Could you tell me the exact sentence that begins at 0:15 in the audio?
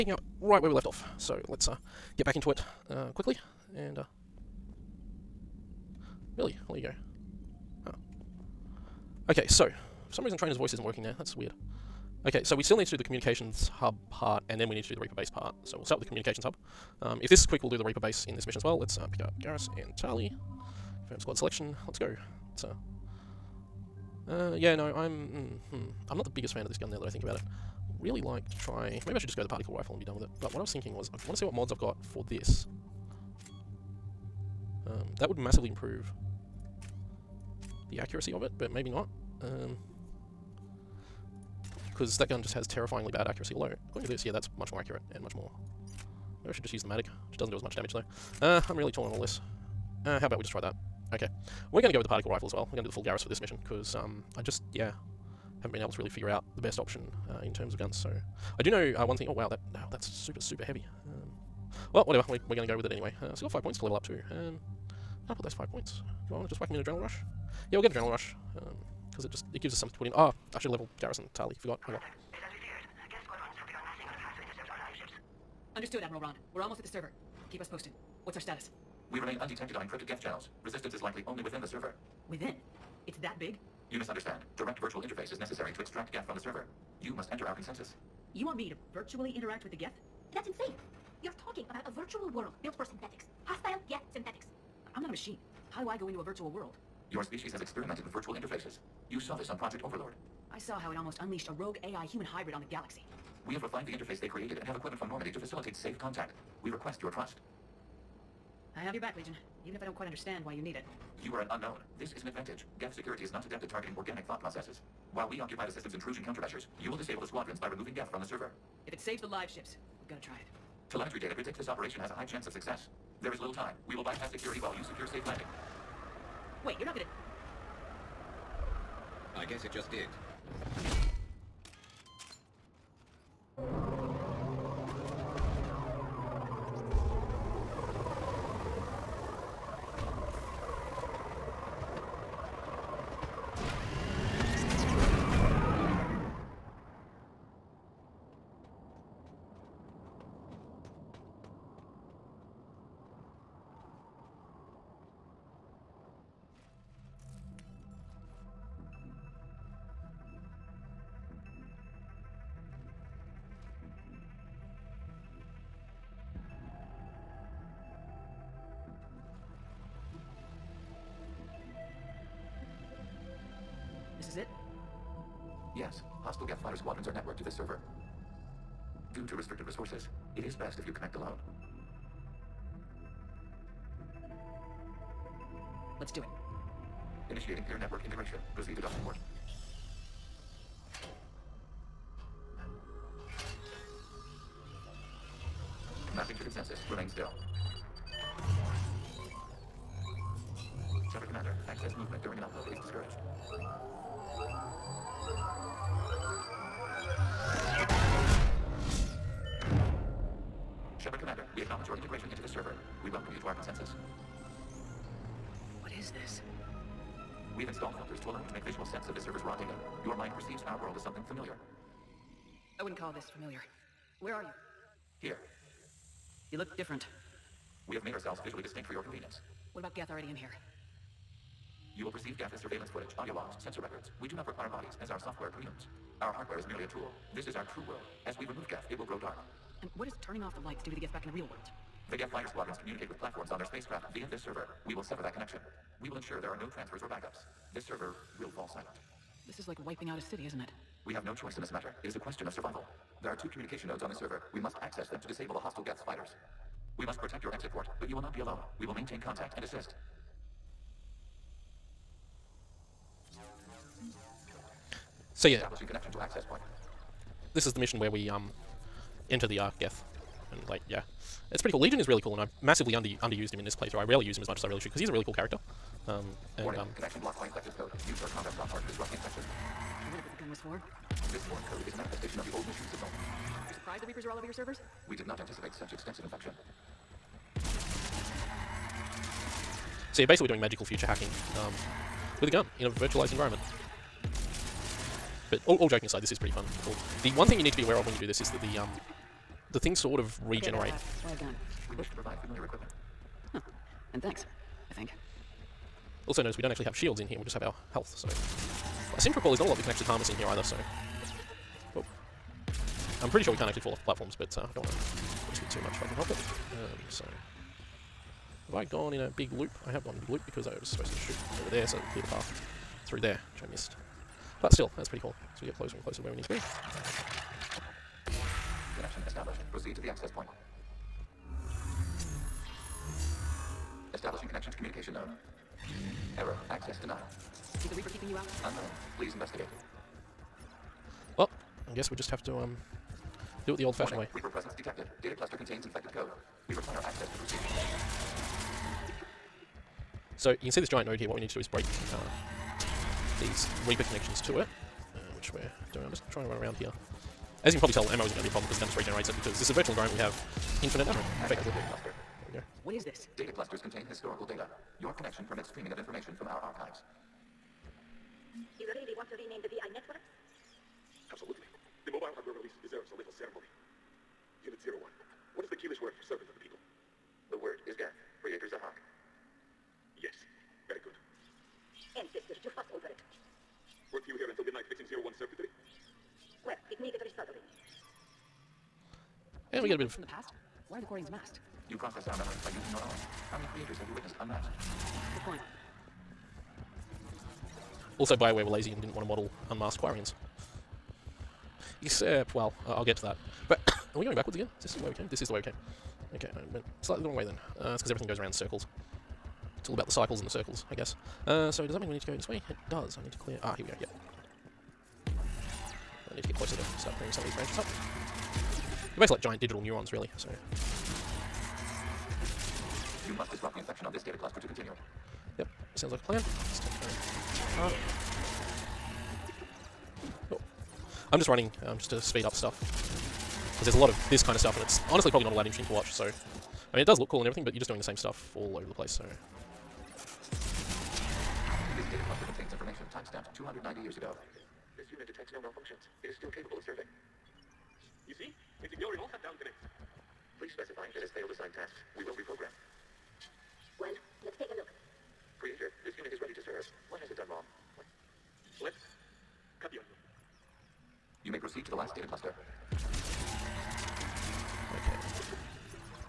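So we'll start with the communications hub.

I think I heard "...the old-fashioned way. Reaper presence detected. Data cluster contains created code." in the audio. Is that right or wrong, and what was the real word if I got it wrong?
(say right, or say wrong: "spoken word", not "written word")
wrong: "infected", not "created".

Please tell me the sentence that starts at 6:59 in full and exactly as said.
They're basically like giant digital neurons, really, so...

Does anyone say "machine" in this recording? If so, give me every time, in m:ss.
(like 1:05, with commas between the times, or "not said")
1:35, 4:42.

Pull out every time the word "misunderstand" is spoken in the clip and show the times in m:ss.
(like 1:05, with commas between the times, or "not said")
1:23.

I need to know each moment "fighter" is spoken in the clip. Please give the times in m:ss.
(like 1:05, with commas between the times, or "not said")
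2:56, 4:02, 4:16.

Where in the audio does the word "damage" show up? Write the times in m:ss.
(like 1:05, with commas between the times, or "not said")
0:47.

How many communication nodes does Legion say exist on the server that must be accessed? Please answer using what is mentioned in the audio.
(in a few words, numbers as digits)
2.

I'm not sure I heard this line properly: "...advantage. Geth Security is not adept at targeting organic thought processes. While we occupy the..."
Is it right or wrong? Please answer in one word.
right.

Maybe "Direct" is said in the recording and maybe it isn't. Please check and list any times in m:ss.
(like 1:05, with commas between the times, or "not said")
1:24.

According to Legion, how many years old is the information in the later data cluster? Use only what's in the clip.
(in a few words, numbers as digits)
290.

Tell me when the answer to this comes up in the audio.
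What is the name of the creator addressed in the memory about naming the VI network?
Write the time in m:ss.
6:18.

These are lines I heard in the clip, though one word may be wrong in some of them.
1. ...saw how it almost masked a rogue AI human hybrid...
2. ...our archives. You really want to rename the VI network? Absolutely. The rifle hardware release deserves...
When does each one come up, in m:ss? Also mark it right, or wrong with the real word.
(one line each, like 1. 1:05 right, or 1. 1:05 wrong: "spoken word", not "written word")
1. 1:40 wrong: "unleashed", not "masked"
2. 6:06 wrong: "mobile", not "rifle".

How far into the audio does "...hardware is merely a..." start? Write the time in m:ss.
3:56.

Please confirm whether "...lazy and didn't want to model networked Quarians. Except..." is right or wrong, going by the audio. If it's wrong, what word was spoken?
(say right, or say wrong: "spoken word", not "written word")
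wrong: "unmasked", not "networked".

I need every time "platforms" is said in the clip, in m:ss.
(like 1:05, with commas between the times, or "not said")
4:03, 5:14.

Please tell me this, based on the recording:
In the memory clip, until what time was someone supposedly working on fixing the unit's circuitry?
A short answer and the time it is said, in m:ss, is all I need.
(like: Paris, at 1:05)
midnight, at 6:24.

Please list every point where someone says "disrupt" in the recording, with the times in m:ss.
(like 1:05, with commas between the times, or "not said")
4:38, 7:03.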